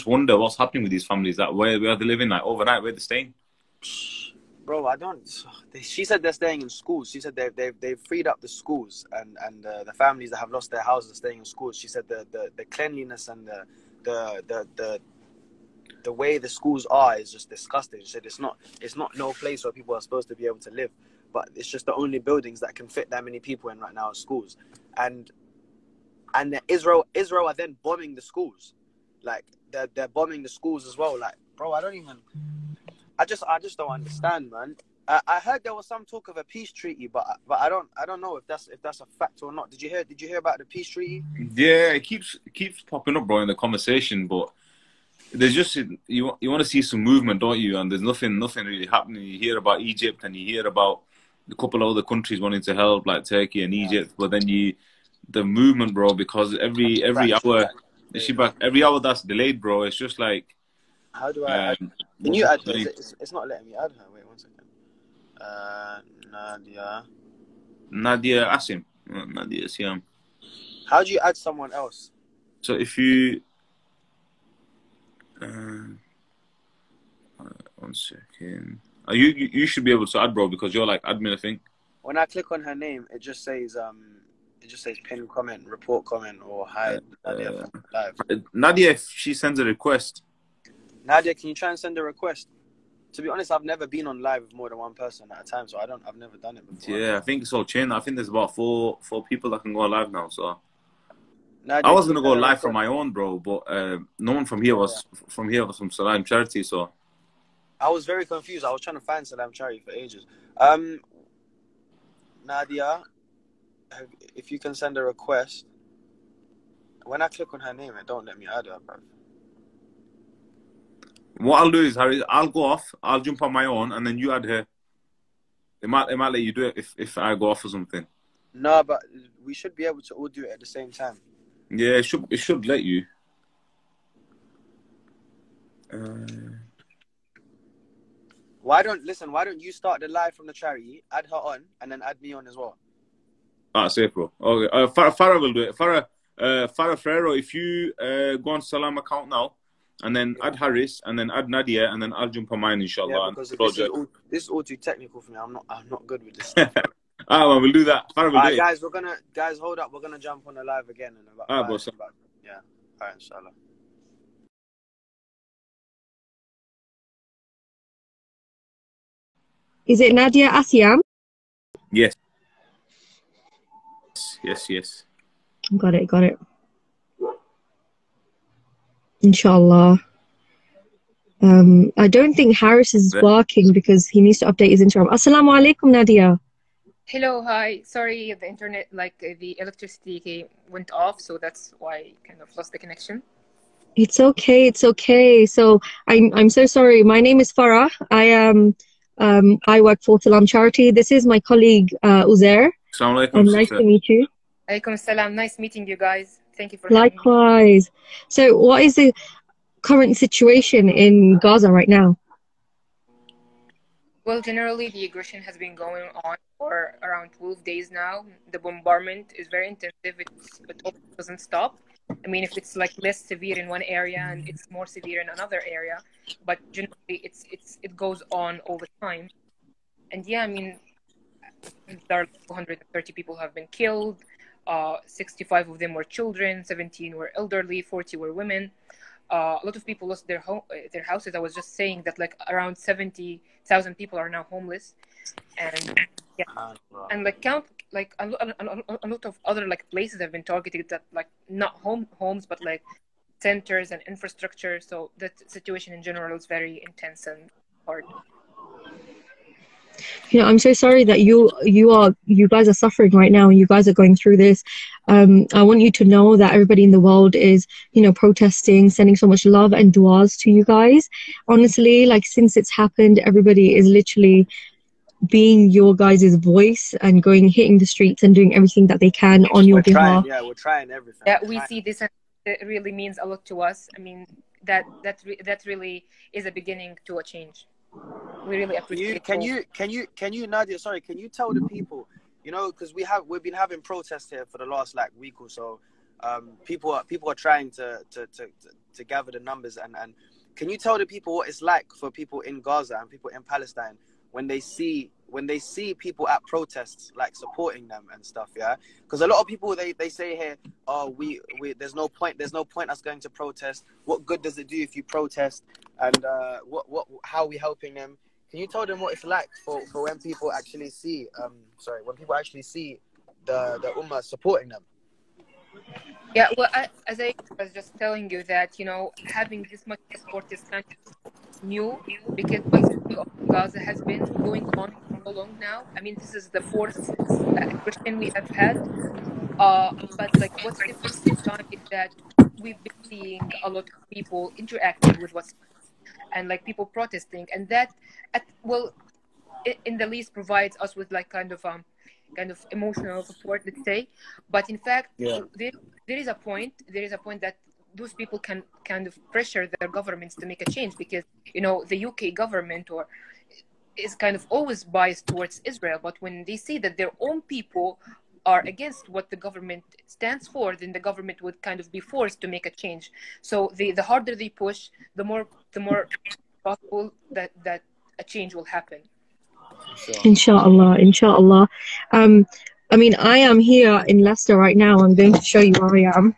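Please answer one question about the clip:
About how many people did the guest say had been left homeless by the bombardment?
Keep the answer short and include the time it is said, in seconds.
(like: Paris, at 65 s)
70,000, at 242 s.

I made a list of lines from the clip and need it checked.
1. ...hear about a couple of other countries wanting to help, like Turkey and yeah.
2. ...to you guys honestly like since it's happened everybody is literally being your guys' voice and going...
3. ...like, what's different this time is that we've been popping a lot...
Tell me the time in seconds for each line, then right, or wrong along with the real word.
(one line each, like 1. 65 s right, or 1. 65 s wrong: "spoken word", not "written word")
1. 50 s right
2. 270 s right
3. 340 s wrong: "seeing", not "popping".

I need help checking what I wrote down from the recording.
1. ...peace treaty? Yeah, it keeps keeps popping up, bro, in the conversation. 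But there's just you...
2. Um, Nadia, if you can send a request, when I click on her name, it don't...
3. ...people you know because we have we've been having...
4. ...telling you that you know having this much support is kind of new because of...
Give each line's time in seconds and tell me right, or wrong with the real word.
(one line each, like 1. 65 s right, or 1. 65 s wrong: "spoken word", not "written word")
1. 40 s right
2. 110 s right
3. 291 s right
4. 327 s right.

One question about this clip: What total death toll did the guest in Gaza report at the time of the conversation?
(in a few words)
130.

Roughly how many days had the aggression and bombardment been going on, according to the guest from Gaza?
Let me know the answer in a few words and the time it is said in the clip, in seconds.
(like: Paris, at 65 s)
12 days, at 217 s.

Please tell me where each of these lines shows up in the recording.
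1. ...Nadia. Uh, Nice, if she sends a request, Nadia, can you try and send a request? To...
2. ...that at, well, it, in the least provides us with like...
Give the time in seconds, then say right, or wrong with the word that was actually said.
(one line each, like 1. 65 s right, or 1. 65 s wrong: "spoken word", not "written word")
1. 87 s wrong: "Nadia", not "Nice"
2. 347 s right.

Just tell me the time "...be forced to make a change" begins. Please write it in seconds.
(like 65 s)
371 s.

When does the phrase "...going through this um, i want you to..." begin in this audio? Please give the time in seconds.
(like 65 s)
263 s.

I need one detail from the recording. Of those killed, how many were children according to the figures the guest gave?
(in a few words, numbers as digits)
65.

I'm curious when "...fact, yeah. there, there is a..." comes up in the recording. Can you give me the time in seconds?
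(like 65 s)
354 s.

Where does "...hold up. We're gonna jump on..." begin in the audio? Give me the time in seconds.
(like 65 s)
159 s.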